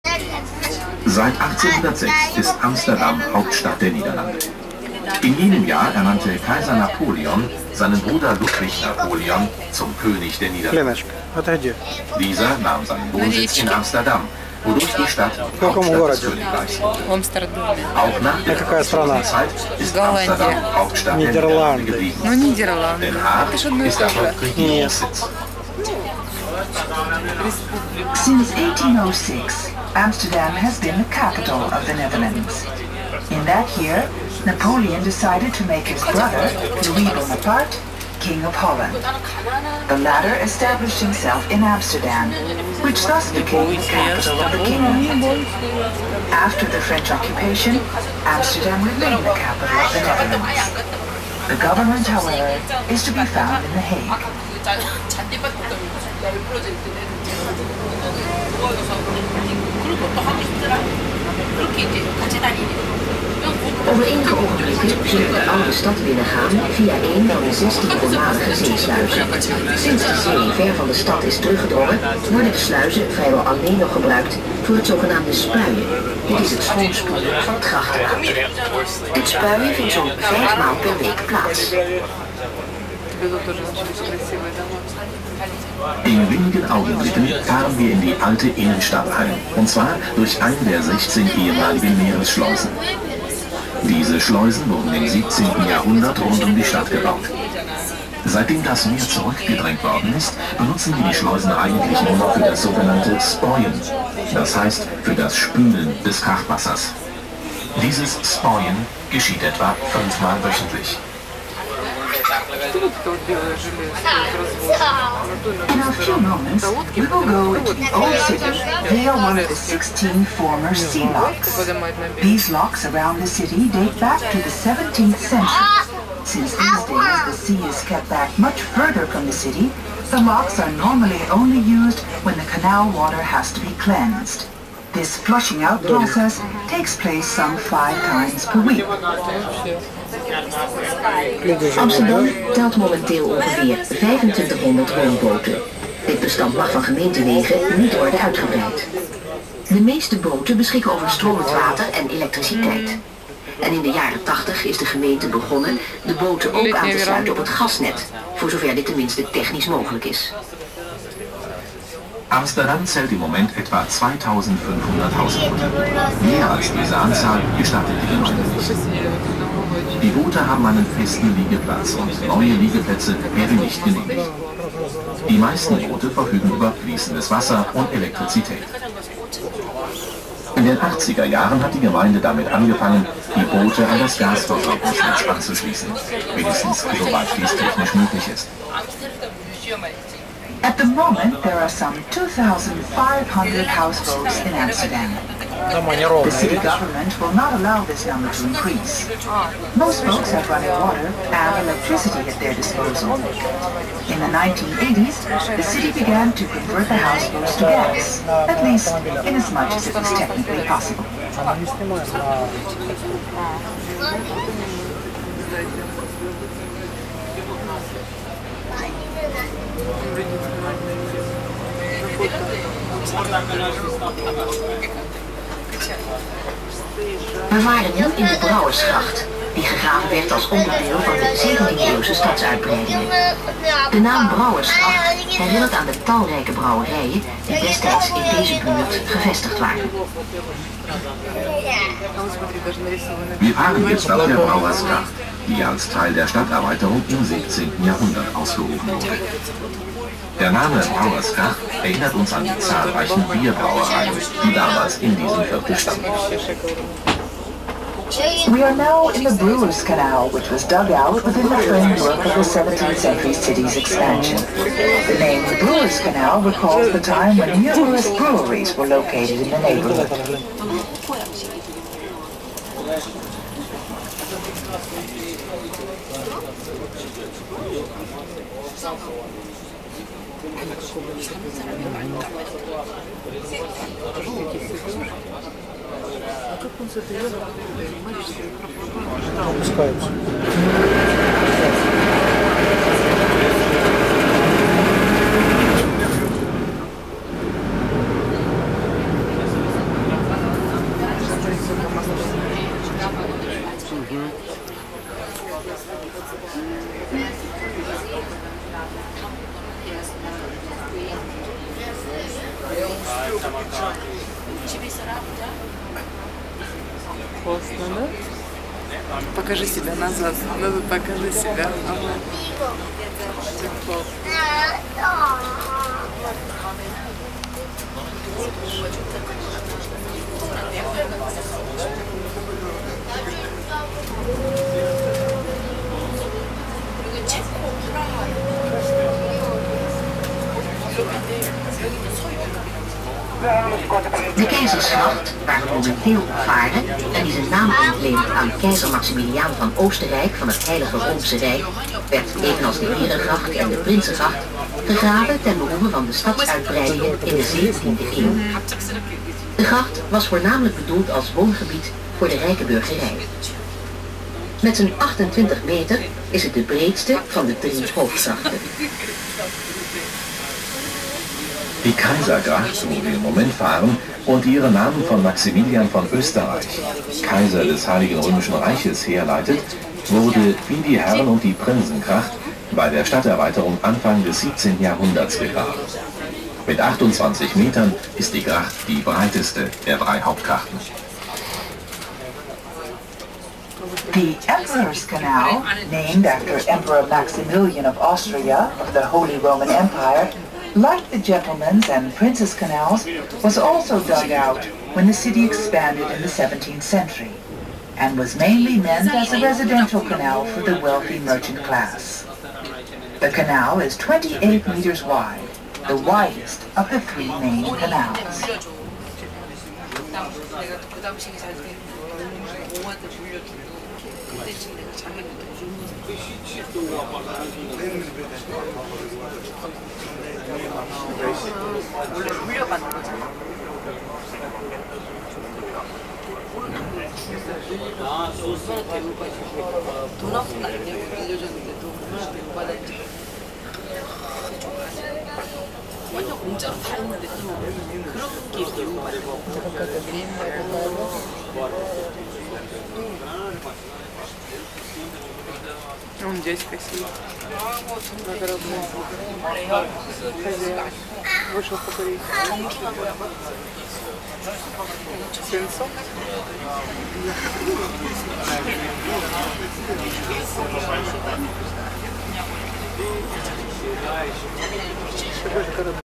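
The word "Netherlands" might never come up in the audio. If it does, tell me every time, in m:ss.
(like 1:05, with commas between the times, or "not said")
0:31, 0:50.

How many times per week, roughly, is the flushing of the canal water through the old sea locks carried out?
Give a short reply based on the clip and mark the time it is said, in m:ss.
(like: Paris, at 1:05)
5, at 2:17.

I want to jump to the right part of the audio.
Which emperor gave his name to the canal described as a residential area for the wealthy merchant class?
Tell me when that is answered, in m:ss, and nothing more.
6:37.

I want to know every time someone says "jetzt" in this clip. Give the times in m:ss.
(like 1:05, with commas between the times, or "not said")
4:03.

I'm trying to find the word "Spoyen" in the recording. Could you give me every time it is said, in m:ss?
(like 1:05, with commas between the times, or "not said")
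1:43, 1:48.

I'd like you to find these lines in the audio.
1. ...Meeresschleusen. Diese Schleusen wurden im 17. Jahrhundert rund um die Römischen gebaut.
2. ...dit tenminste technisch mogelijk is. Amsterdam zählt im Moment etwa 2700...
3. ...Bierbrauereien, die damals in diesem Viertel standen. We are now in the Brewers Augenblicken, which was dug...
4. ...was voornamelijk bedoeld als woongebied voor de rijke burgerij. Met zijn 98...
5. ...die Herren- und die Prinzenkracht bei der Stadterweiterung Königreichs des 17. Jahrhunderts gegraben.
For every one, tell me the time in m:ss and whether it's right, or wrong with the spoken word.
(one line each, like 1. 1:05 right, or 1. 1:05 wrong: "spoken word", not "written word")
1. 1:32 wrong: "Stadt", not "Römischen"
2. 2:38 wrong: "2500", not "2700"
3. 4:13 wrong: "Canal", not "Augenblicken"
4. 6:00 wrong: "28", not "98"
5. 6:20 wrong: "Anfang", not "Königreichs".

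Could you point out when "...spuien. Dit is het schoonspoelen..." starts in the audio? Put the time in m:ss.
1:15.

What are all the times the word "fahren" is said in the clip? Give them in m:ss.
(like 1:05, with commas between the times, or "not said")
1:27, 6:13.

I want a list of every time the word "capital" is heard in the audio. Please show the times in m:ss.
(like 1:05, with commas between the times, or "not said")
0:31, 0:43, 0:49.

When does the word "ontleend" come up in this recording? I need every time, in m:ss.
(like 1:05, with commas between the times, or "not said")
5:47.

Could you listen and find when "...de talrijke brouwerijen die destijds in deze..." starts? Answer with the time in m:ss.
3:55.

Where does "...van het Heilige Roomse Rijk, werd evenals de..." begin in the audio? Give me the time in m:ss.
5:50.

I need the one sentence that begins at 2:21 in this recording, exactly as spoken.
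Amsterdam telt momenteel ongeveer 2500 woonboten.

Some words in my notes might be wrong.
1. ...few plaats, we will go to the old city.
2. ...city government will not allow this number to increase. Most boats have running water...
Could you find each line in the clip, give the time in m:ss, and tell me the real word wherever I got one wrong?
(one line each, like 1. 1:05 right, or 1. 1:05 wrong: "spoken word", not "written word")
1. 1:55 wrong: "moments", not "plaats"
2. 3:16 right.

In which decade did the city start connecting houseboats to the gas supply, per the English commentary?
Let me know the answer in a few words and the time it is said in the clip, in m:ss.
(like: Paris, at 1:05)
1980s, at 3:24.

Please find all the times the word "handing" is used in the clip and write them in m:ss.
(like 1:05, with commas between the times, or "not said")
not said.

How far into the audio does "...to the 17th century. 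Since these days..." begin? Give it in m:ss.
2:04.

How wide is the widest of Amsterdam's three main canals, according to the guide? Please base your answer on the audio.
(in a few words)
28 meters.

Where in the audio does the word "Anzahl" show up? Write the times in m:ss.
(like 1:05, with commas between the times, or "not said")
2:46.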